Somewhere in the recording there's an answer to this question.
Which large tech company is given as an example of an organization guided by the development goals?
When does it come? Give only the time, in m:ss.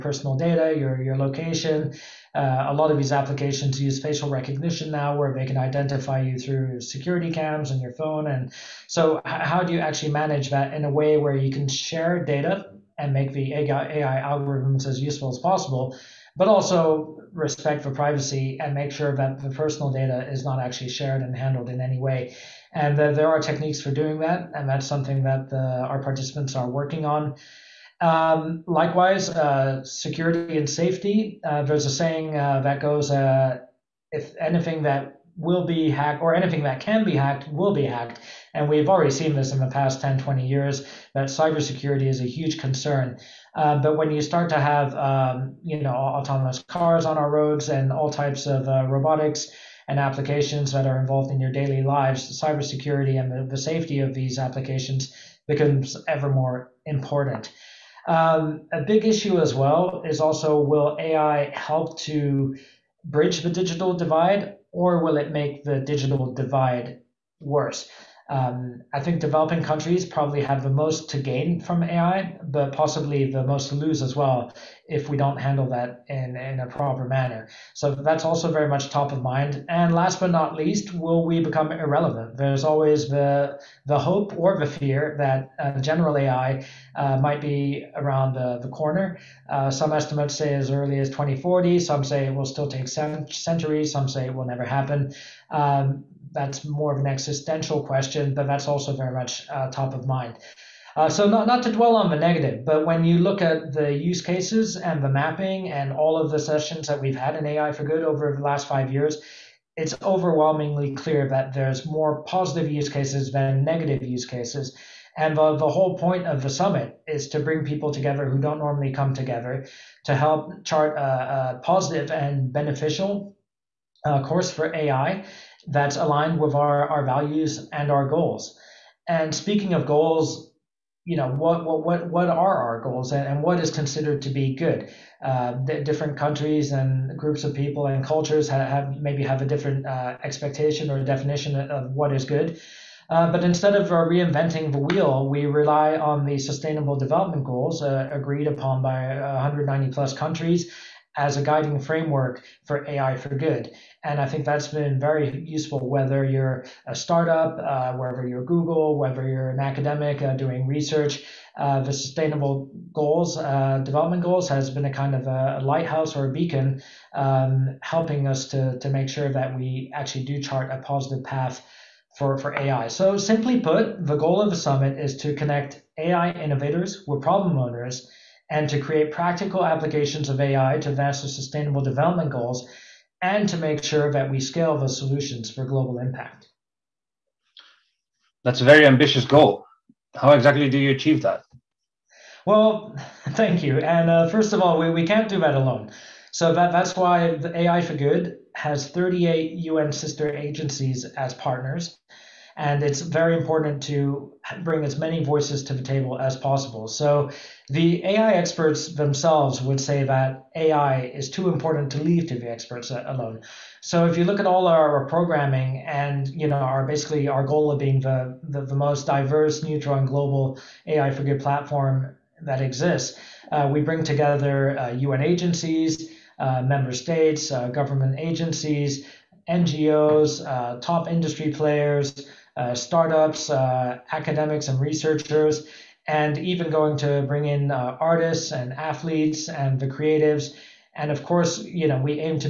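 2:38.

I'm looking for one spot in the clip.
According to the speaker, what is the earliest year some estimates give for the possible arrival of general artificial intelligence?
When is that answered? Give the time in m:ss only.
1:31.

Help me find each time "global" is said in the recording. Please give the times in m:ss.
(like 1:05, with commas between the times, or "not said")
3:05, 3:40.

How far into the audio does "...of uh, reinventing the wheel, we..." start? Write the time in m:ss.
2:23.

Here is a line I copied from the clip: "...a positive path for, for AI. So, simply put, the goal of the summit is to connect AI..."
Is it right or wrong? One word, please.
right.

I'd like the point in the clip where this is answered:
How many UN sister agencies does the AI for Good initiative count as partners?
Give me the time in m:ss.
3:18.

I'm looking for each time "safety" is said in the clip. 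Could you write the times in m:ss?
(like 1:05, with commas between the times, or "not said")
0:30, 0:53.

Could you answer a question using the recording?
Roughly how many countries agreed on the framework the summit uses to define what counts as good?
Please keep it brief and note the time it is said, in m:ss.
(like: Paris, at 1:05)
190 plus, at 2:29.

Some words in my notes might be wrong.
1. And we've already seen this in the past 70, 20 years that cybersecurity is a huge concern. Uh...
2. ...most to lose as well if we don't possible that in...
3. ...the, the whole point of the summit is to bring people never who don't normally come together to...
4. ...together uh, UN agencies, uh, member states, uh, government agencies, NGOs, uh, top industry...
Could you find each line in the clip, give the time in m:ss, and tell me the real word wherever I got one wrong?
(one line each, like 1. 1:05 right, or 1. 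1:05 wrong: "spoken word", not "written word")
1. 0:38 wrong: "10", not "70"
2. 1:13 wrong: "handle", not "possible"
3. 1:55 wrong: "together", not "never"
4. 3:44 right.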